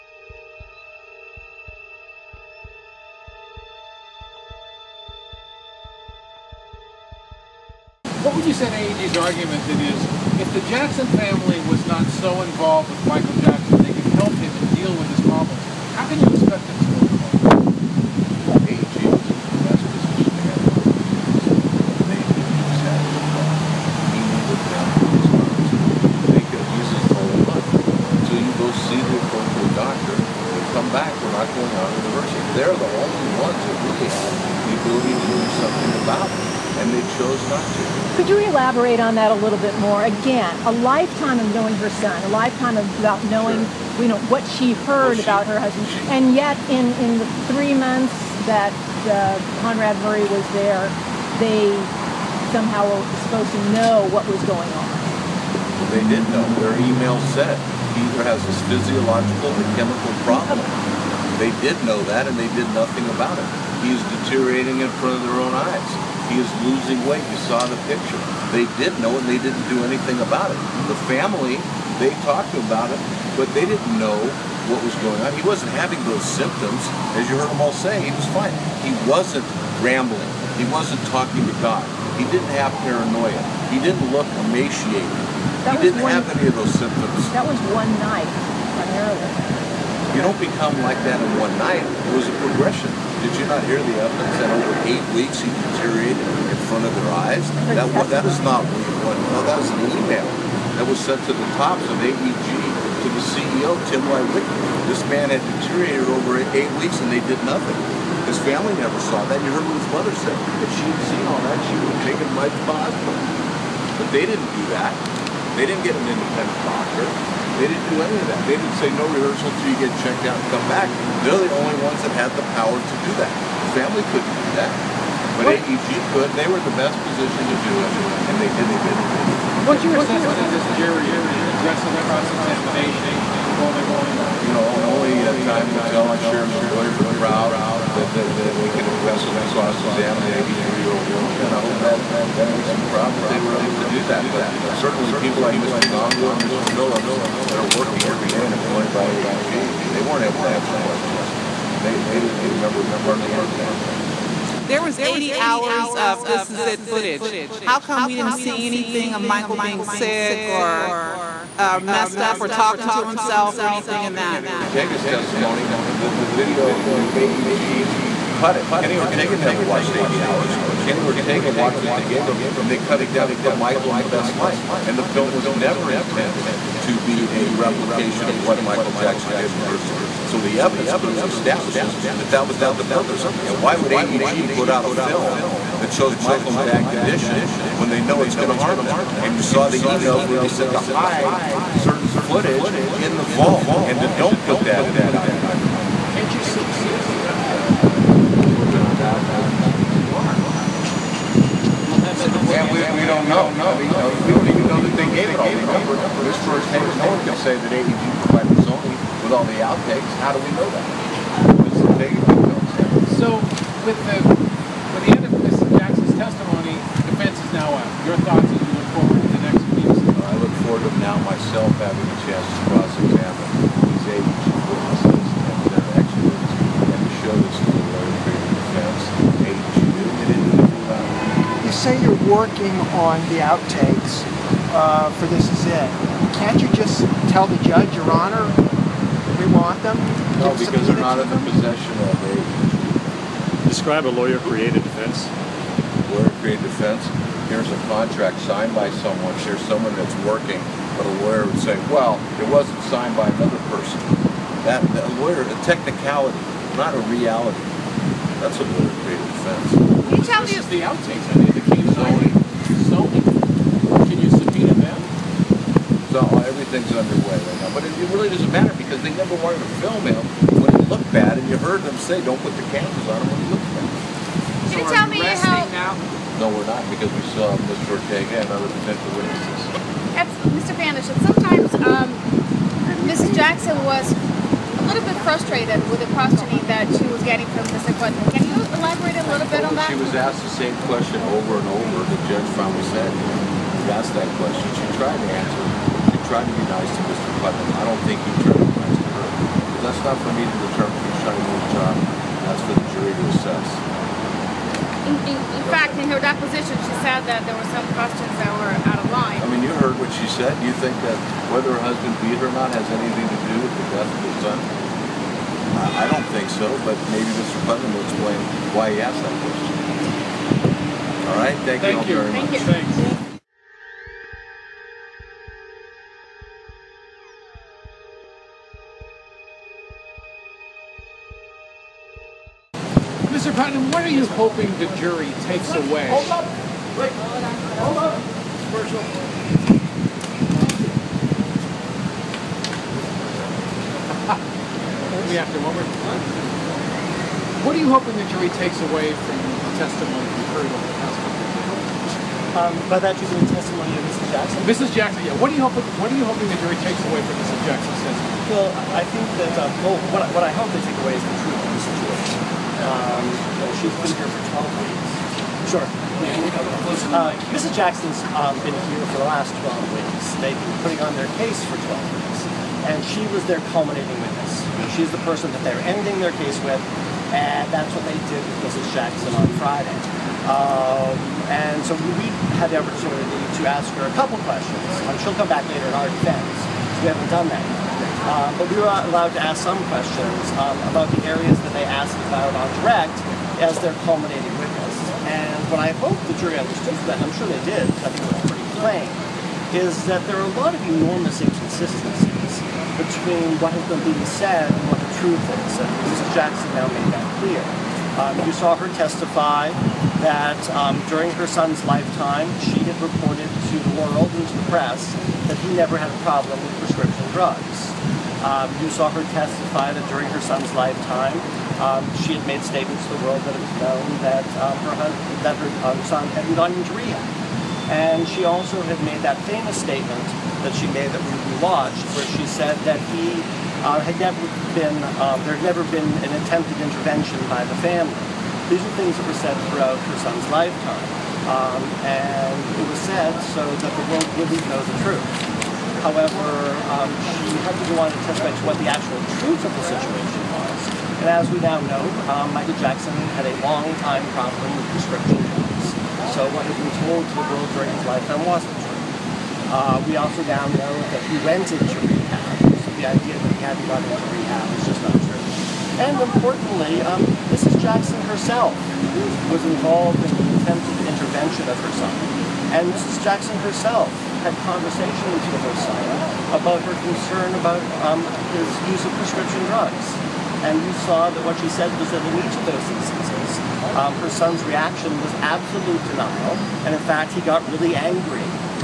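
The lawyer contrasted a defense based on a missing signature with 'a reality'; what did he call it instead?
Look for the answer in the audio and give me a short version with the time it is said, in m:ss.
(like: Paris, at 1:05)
a technicality, at 4:15.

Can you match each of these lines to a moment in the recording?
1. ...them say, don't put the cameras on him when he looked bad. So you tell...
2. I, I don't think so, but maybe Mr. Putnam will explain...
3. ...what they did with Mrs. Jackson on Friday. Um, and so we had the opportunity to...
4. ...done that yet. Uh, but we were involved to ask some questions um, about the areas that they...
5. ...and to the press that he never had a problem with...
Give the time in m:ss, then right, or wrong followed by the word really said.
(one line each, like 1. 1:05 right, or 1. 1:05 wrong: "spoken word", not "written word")
1. 4:31 right
2. 5:15 right
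3. 6:17 right
4. 6:27 wrong: "allowed", not "involved"
5. 6:54 right.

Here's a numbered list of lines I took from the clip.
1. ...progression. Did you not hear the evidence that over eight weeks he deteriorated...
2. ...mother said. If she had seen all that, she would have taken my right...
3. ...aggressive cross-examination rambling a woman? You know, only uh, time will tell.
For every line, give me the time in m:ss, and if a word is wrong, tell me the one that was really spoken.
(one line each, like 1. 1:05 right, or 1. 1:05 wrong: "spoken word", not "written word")
1. 1:32 right
2. 1:49 right
3. 2:11 wrong: "involving", not "rambling".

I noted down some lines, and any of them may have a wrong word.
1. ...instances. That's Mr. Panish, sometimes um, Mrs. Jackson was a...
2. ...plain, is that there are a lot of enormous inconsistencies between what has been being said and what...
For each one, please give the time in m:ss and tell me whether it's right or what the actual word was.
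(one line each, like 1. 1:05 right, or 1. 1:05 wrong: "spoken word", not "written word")
1. 4:39 wrong: "witnesses", not "instances"
2. 6:38 right.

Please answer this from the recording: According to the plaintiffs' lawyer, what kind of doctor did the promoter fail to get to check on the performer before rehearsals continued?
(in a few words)
independent doctor.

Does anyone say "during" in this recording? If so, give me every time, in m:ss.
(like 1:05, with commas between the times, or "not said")
6:51, 7:00, 7:37.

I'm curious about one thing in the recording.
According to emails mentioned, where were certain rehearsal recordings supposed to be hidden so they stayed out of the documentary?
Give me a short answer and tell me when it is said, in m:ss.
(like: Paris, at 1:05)
the vault, at 3:13.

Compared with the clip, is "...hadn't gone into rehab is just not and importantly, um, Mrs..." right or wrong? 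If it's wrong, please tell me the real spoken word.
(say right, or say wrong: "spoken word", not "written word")
right.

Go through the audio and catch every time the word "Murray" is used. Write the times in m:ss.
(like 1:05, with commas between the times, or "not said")
0:50.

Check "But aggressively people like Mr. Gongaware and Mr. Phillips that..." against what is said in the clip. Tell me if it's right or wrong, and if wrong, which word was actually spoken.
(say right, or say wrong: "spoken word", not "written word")
wrong: "certainly", not "aggressively".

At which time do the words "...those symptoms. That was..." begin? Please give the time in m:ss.
1:26.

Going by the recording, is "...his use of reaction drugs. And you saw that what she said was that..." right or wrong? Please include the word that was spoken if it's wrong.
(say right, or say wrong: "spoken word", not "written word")
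wrong: "prescription", not "reaction".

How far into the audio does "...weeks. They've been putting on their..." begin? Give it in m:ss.
6:09.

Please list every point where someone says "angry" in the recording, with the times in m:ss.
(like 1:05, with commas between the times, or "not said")
8:07.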